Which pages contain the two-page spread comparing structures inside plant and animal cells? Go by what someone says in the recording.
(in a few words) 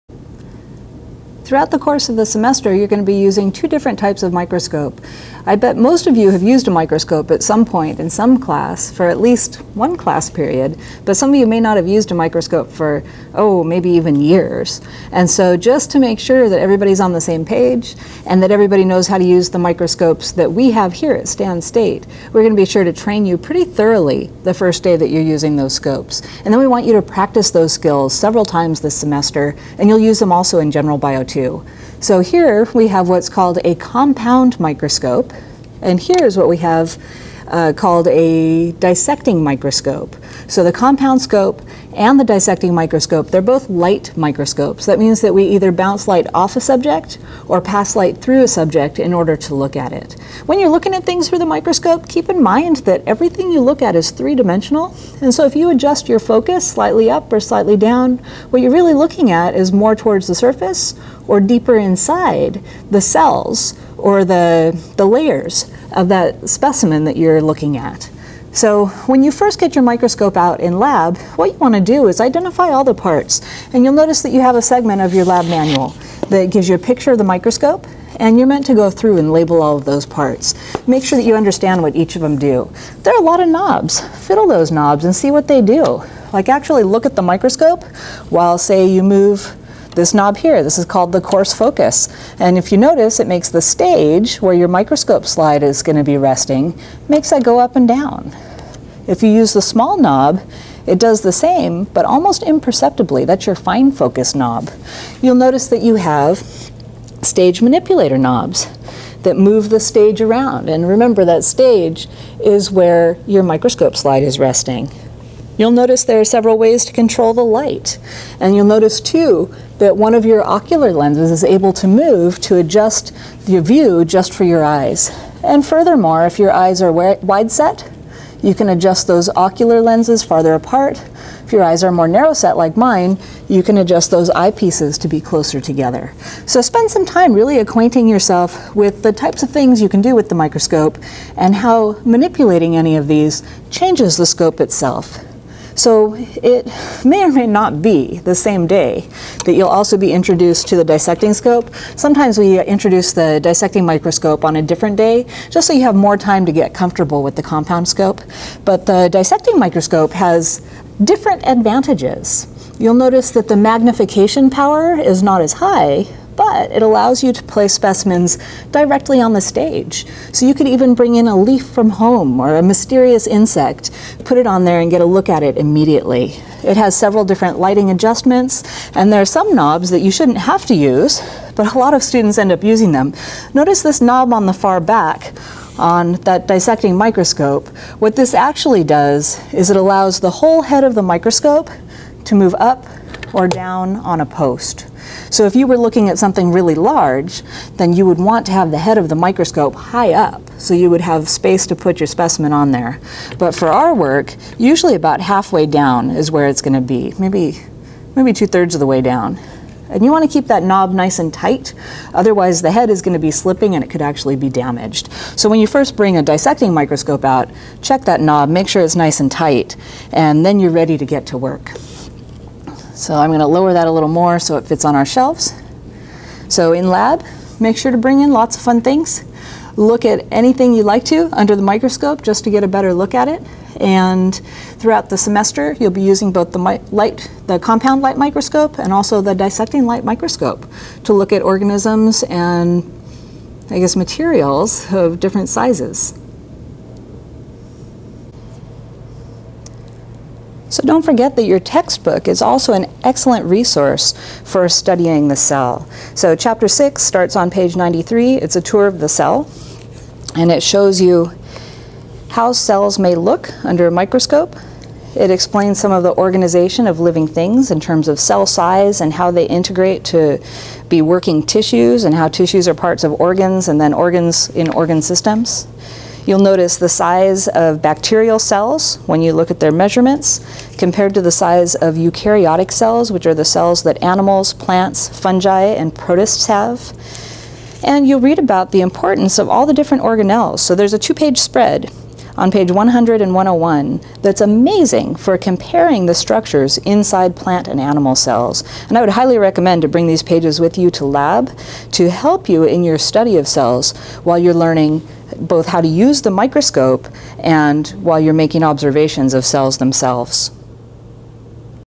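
100 and 101.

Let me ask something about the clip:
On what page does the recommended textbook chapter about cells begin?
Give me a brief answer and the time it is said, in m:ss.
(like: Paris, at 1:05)
93, at 4:17.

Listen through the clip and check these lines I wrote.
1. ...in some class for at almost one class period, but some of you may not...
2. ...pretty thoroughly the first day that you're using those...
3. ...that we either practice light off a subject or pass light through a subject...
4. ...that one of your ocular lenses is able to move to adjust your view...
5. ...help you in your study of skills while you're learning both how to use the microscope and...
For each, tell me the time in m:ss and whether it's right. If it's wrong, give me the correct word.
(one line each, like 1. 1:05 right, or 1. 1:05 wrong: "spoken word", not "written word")
1. 0:07 wrong: "least", not "almost"
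2. 0:23 right
3. 0:45 wrong: "bounce", not "practice"
4. 1:59 right
5. 5:02 wrong: "cells", not "skills".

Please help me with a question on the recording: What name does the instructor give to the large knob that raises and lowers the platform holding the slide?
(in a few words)
coarse focus.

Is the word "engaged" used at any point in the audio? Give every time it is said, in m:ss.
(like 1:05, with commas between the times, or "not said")
not said.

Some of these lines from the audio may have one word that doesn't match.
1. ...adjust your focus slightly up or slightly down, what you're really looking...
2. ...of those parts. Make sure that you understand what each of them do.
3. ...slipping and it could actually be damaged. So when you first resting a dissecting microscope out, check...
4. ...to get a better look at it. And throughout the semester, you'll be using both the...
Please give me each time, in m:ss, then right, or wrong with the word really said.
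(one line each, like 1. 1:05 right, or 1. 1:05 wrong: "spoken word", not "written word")
1. 0:55 right
2. 1:19 right
3. 3:33 wrong: "bring", not "resting"
4. 3:52 right.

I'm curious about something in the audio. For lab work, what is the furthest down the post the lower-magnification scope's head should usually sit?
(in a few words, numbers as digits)
two-thirds.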